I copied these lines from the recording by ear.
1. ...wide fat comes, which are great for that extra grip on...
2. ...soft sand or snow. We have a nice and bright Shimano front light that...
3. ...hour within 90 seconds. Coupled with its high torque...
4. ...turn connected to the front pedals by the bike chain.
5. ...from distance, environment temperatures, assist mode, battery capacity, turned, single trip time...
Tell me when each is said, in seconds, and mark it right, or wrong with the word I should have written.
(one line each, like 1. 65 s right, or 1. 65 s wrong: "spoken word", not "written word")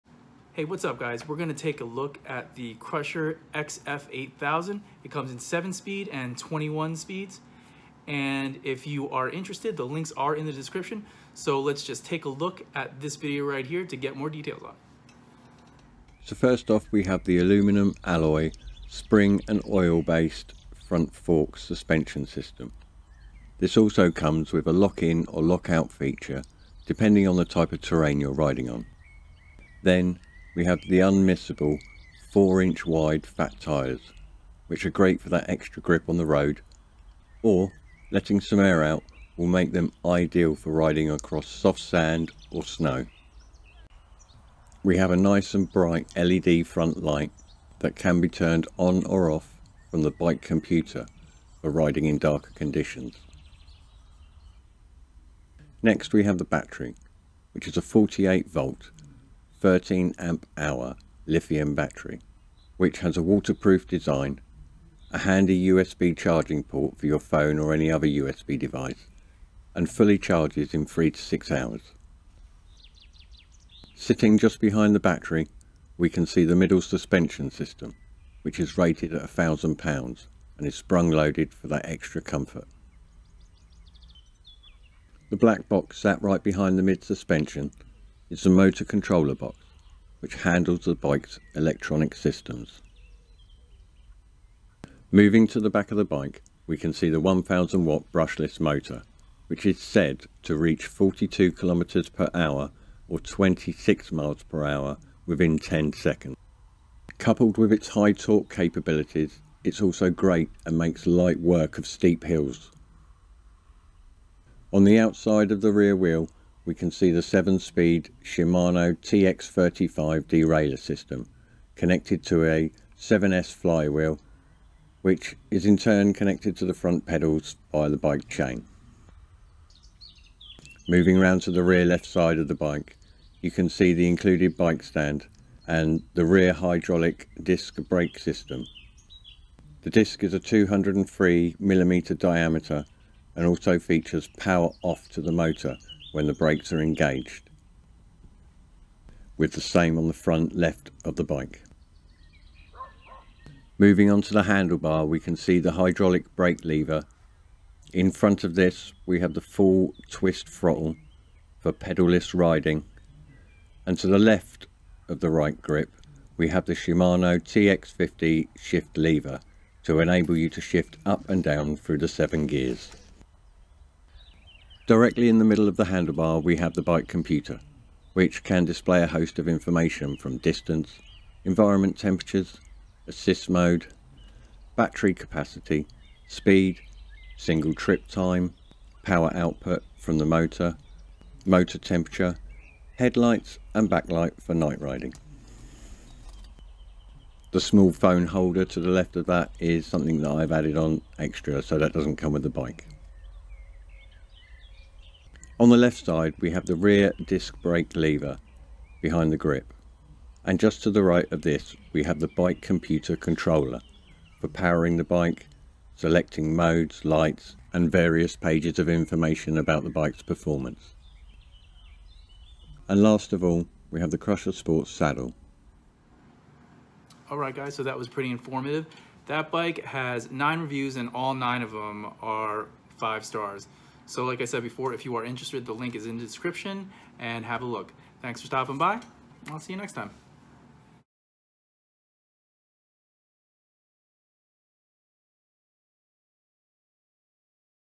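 1. 32 s wrong: "tyres", not "comes"
2. 41 s wrong: "LED", not "Shimano"
3. 104 s wrong: "10", not "90"
4. 125 s right
5. 180 s wrong: "speed", not "turned".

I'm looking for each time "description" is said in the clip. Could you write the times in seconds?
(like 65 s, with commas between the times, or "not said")
10 s, 236 s.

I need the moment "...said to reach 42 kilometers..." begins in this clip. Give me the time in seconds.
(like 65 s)
99 s.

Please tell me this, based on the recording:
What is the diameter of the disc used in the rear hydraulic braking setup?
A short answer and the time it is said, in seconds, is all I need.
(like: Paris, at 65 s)
203mm, at 140 s.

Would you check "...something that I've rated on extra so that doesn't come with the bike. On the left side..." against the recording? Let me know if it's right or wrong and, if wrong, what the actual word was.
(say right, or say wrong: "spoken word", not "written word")
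wrong: "added", not "rated".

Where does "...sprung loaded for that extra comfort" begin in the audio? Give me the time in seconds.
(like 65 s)
80 s.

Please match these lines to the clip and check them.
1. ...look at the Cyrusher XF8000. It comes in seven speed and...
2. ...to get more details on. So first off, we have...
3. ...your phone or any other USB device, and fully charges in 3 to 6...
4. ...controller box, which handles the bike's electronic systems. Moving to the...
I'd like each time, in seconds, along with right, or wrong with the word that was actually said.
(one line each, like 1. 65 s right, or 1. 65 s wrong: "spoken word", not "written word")
1. 1 s right
2. 13 s right
3. 67 s right
4. 88 s right.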